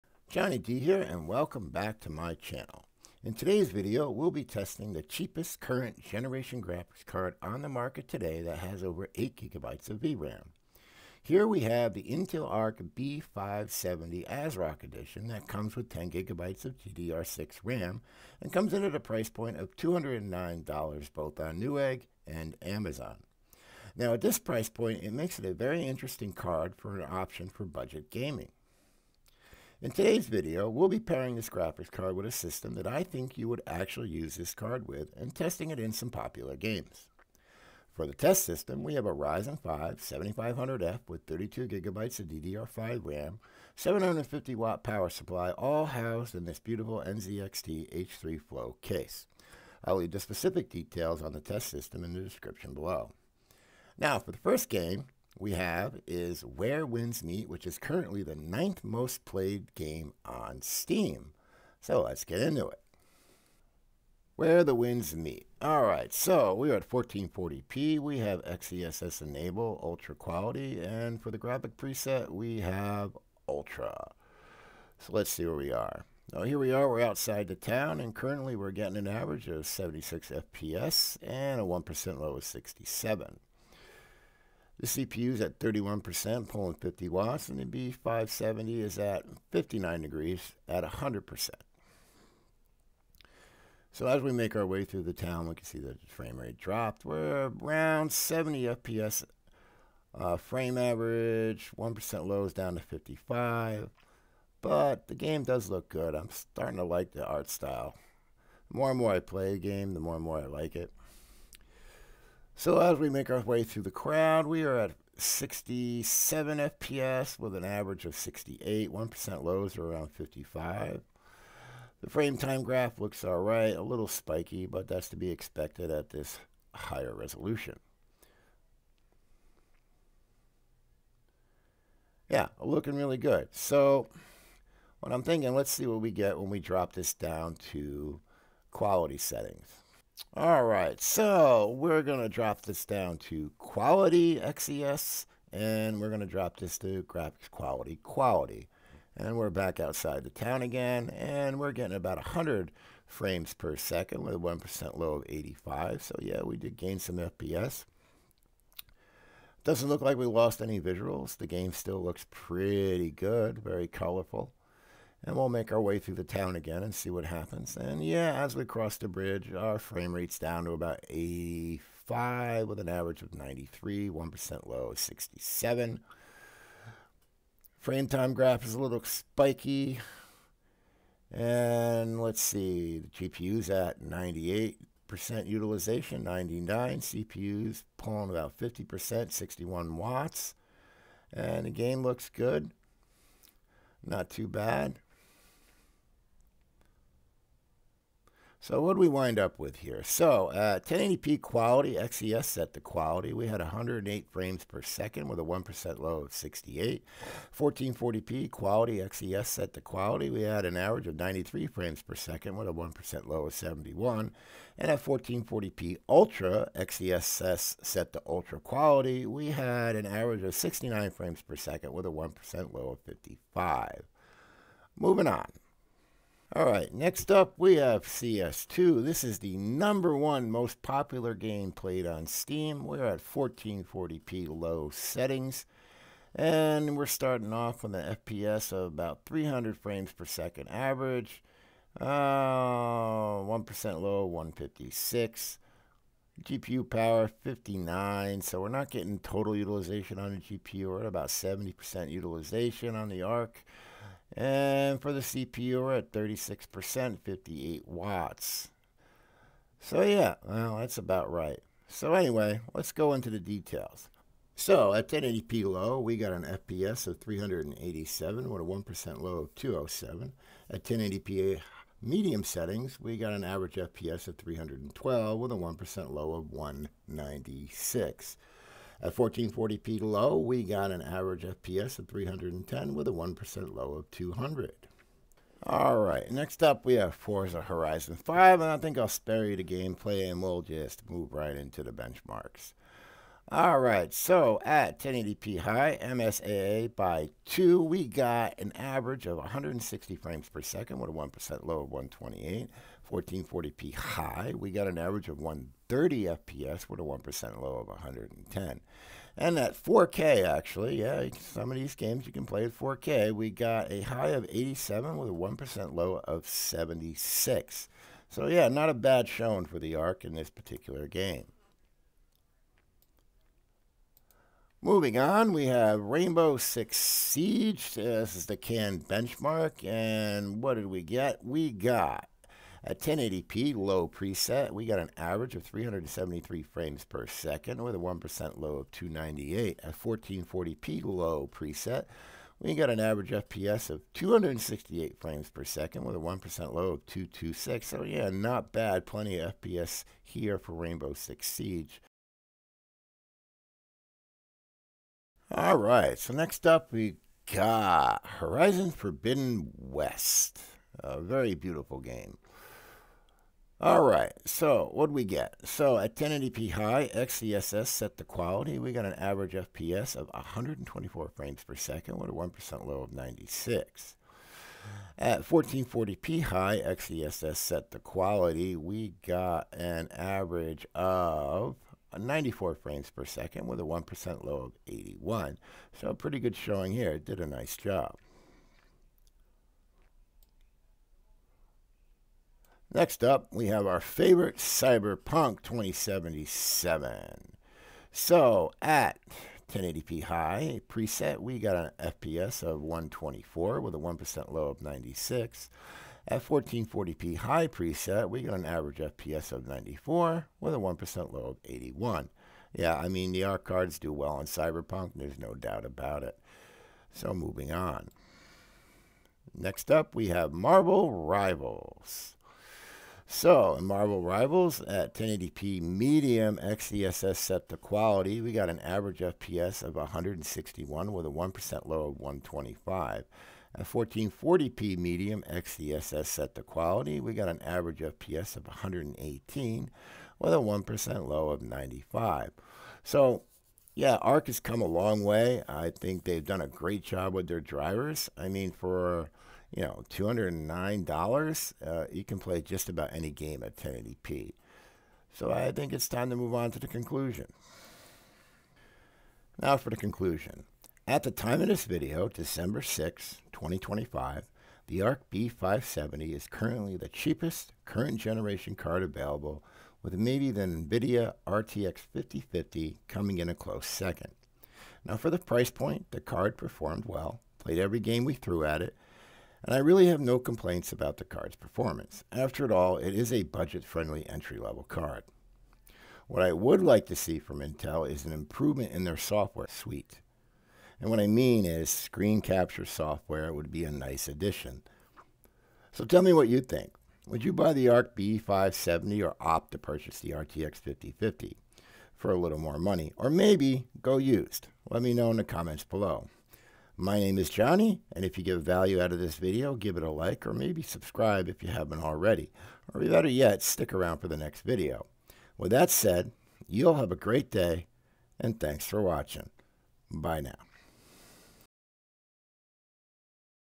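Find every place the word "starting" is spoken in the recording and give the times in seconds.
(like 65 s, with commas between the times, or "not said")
106 s, 237 s.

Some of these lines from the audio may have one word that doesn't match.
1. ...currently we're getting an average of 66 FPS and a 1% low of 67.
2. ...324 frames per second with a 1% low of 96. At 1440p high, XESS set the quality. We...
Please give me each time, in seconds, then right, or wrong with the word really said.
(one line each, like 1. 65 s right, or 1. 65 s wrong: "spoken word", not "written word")
1. 78 s wrong: "76", not "66"
2. 370 s wrong: "124", not "324".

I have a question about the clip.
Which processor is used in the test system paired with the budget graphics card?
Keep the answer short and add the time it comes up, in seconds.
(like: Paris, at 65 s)
Ryzen 5 7500F, at 39 s.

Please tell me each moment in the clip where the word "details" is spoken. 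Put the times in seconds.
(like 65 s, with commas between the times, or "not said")
50 s, 263 s.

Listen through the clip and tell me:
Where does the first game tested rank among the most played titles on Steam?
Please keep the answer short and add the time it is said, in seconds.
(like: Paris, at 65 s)
ninth, at 58 s.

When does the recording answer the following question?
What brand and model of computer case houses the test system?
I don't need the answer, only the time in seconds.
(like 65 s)
47 s.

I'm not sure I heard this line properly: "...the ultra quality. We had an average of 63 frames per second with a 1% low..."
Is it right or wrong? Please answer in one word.
wrong.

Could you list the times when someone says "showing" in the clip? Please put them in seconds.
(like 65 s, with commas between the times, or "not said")
319 s, 386 s.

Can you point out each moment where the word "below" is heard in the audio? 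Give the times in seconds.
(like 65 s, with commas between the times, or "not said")
52 s, 505 s.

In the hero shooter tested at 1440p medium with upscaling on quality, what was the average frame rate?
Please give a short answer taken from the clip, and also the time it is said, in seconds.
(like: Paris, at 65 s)
118, at 438 s.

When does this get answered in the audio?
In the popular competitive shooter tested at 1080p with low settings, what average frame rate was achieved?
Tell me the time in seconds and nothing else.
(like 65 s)
267 s.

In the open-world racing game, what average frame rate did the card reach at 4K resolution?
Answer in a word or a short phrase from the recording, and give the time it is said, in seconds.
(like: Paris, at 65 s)
87, at 314 s.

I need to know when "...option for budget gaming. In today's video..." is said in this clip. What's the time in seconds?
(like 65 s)
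27 s.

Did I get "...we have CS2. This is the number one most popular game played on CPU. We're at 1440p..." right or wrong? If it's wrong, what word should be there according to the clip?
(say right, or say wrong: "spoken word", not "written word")
wrong: "Steam", not "CPU".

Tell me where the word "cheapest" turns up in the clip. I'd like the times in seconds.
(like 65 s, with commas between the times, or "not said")
5 s, 467 s.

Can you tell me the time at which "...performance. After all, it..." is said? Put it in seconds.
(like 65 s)
481 s.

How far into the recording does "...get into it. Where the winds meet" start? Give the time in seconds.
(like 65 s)
62 s.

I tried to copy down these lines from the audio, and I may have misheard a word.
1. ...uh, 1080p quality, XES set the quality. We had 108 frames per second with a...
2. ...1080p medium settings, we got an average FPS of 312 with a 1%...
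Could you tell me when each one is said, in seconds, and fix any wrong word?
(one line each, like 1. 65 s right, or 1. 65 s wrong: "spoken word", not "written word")
1. 200 s right
2. 270 s right.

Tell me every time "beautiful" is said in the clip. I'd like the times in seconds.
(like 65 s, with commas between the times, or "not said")
46 s, 361 s.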